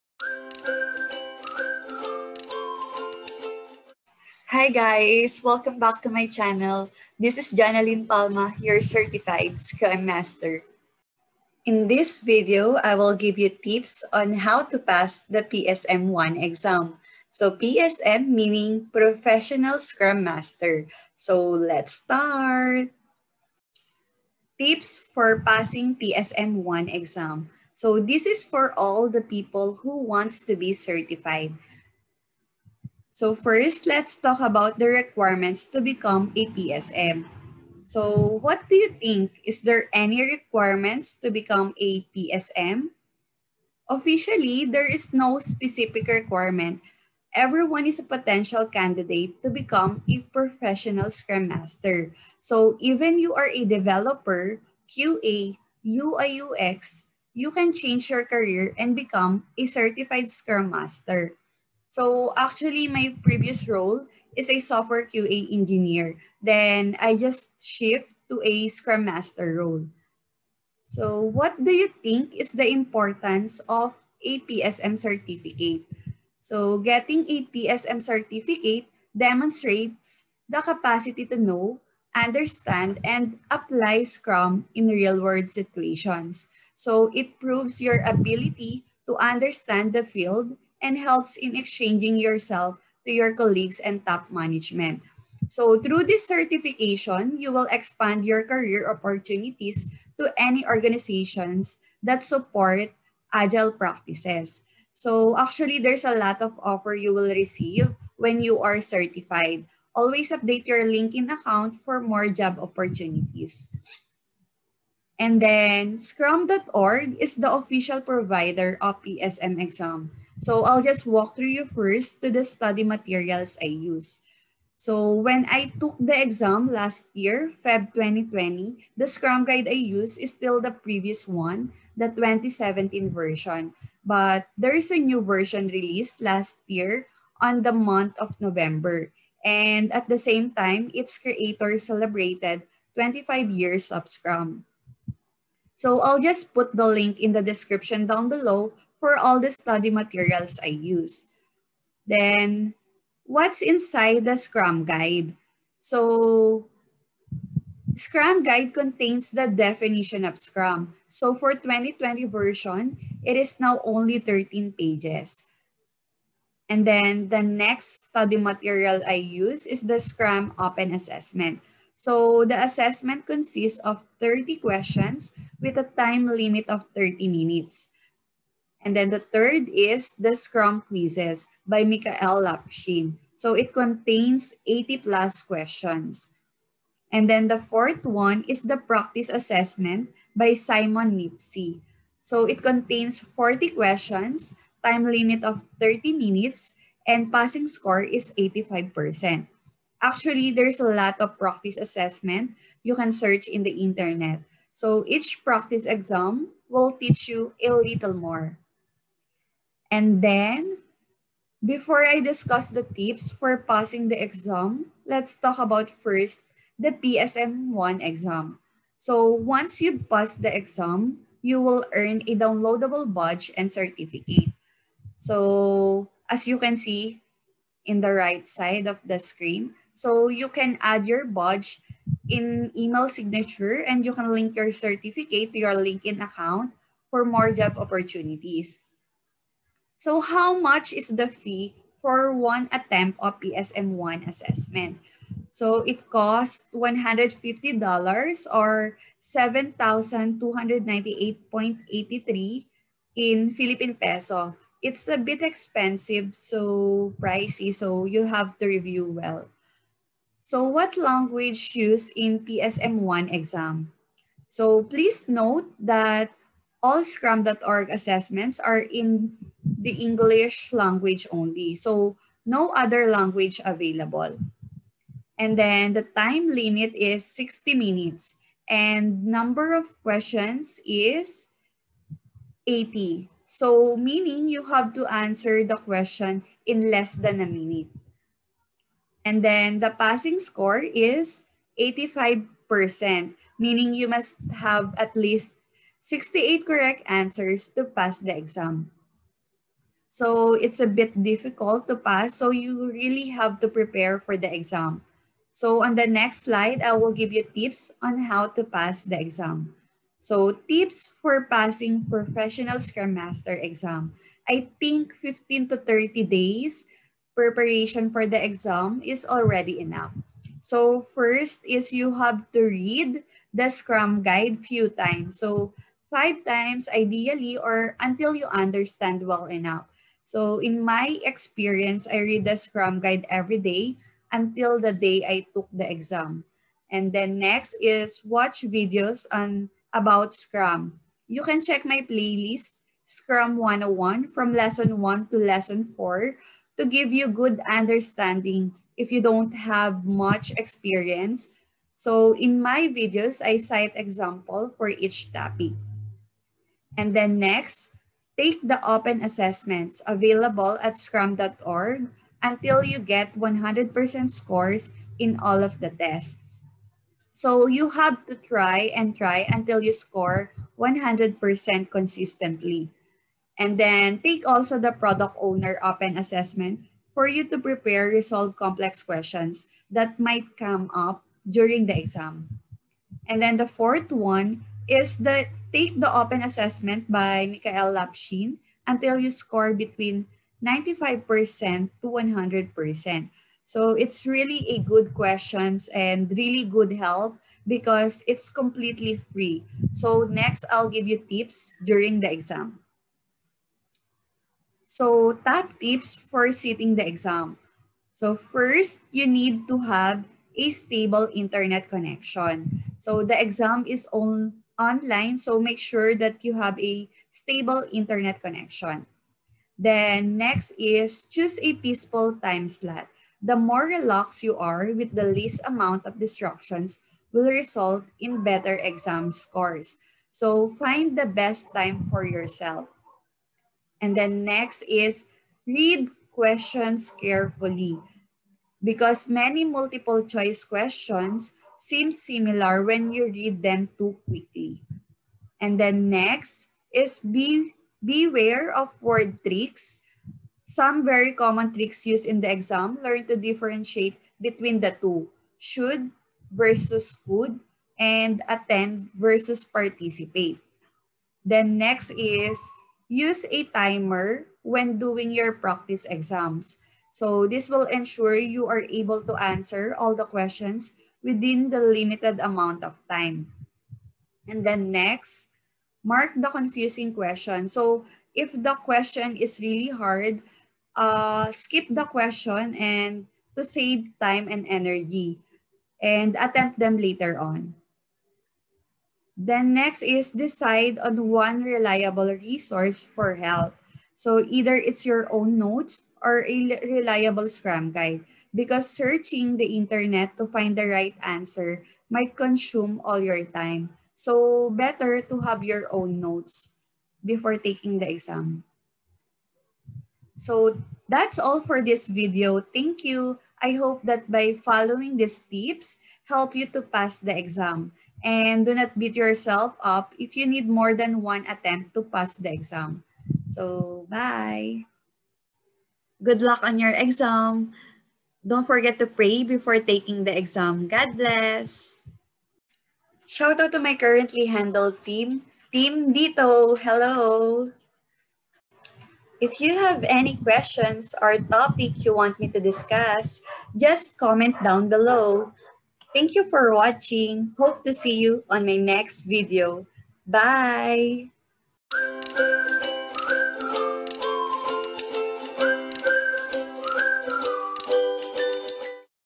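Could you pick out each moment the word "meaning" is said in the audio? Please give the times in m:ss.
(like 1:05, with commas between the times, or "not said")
0:18, 4:43, 4:53.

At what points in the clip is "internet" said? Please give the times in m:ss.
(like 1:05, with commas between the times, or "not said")
3:23, 6:51, 6:57, 8:19.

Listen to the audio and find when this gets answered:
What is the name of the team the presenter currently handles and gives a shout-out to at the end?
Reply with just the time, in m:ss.
8:55.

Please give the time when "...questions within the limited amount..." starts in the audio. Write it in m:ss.
7:50.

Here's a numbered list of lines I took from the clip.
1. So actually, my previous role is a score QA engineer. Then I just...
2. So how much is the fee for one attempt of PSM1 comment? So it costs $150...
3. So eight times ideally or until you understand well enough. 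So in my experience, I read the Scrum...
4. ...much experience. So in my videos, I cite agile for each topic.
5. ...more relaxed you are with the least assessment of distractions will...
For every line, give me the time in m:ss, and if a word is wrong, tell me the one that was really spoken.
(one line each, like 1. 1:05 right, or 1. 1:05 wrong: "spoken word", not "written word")
1. 1:01 wrong: "software", not "score"
2. 4:00 wrong: "assessment", not "comment"
3. 5:25 wrong: "five", not "eight"
4. 5:50 wrong: "example", not "agile"
5. 7:03 wrong: "amount", not "assessment".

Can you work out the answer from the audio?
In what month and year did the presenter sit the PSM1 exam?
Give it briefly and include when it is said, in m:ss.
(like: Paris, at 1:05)
Feb 2020, at 2:07.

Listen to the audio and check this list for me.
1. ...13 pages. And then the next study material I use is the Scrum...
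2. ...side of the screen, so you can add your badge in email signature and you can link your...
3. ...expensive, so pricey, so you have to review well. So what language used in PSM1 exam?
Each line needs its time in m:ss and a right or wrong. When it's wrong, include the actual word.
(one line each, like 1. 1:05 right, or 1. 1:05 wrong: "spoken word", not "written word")
1. 2:44 right
2. 3:48 right
3. 4:15 right.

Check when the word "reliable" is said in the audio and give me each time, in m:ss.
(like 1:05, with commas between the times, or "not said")
8:11, 8:16.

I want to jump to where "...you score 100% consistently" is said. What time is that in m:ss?
6:09.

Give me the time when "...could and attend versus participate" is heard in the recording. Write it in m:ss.
7:37.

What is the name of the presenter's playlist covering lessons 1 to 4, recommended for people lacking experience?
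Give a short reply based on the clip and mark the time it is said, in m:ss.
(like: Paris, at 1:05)
Scrum 101, at 5:43.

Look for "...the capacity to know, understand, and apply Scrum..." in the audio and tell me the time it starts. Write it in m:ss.
1:20.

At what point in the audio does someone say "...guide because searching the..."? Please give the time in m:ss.
8:17.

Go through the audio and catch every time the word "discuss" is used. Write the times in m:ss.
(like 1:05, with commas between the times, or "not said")
3:32, 9:02.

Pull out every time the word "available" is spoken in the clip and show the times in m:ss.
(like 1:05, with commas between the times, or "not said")
4:33, 6:00.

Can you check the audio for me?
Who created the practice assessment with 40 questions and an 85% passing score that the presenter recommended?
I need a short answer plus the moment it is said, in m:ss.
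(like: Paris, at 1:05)
Simon Kneafsey, at 3:10.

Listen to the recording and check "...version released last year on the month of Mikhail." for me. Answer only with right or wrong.
wrong.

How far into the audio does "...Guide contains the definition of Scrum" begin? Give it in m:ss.
2:38.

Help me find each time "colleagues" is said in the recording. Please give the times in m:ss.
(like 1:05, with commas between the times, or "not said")
1:33.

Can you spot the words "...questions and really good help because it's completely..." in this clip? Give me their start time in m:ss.
6:35.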